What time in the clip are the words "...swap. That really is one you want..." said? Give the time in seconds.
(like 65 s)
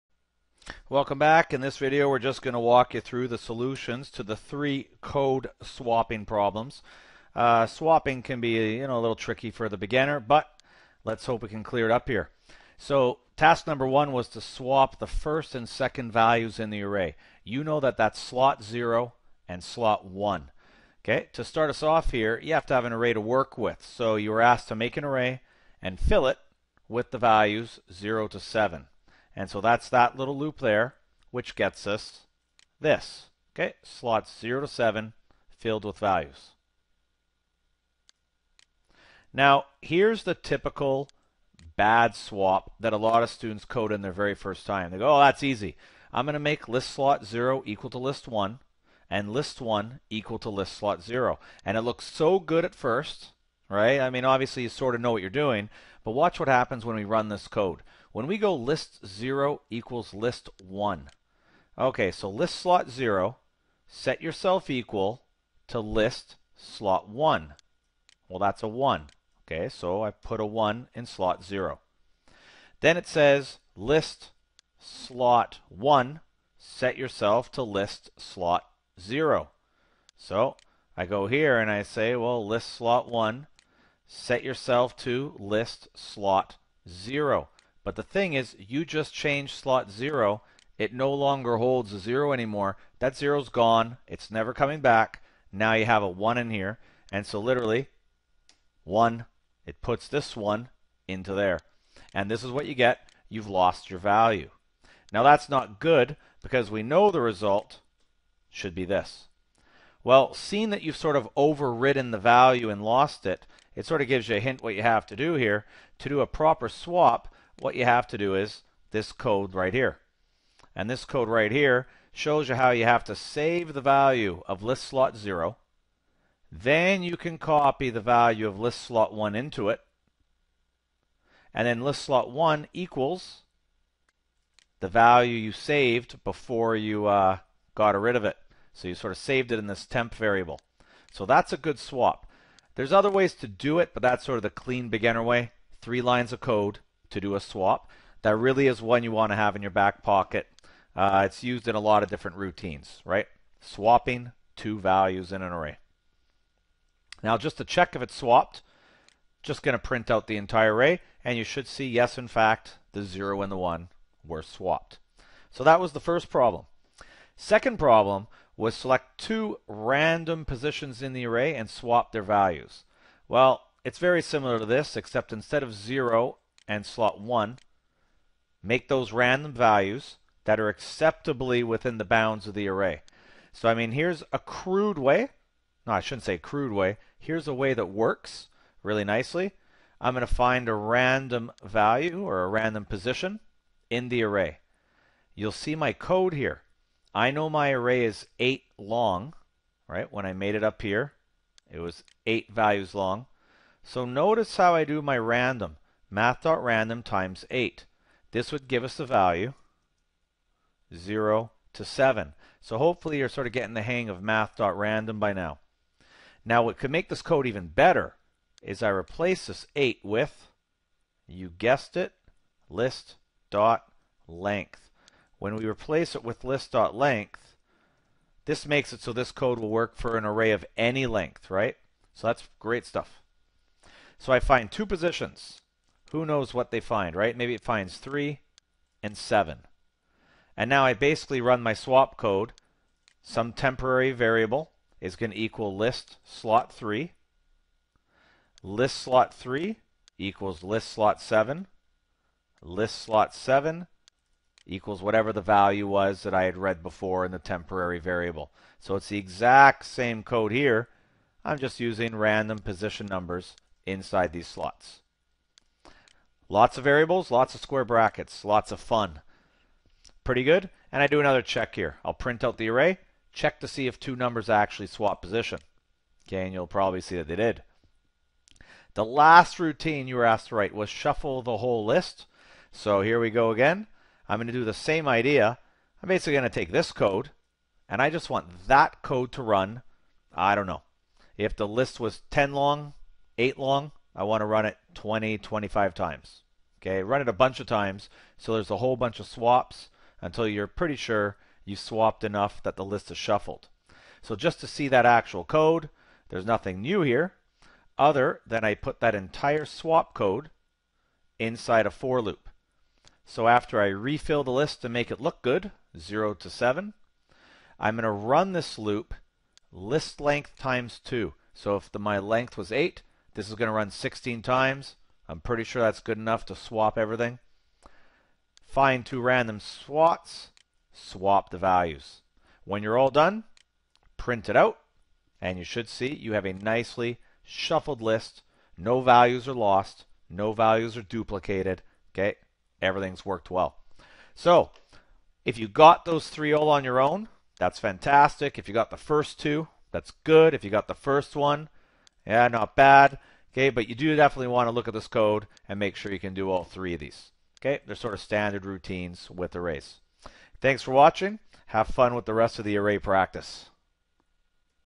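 147 s.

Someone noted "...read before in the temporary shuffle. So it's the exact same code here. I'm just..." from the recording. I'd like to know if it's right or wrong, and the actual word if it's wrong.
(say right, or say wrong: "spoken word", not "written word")
wrong: "variable", not "shuffle".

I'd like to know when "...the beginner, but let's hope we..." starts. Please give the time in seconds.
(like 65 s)
9 s.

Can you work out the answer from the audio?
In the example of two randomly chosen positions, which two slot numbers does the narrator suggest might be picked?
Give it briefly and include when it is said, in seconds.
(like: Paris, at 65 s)
3 and 7, at 237 s.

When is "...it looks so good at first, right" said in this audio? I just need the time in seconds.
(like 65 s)
51 s.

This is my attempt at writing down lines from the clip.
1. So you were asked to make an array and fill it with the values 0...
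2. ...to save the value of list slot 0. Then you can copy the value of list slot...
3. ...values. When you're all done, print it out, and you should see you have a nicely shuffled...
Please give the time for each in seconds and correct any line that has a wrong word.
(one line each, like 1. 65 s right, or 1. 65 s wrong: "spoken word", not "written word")
1. 23 s right
2. 123 s right
3. 331 s right.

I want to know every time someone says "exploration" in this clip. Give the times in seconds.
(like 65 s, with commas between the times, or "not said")
not said.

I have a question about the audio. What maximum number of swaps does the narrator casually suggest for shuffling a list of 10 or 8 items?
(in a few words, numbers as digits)
25.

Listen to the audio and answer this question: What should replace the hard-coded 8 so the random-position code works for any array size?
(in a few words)
list.length.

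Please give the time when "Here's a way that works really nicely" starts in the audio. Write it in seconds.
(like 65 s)
187 s.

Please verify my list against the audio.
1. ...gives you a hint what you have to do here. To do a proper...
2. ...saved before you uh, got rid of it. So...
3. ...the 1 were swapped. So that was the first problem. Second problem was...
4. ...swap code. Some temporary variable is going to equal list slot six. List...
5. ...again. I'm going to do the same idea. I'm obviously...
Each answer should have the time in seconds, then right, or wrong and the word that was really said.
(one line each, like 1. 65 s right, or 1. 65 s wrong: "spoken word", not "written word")
1. 114 s right
2. 135 s right
3. 163 s right
4. 241 s wrong: "three", not "six"
5. 283 s wrong: "basically", not "obviously".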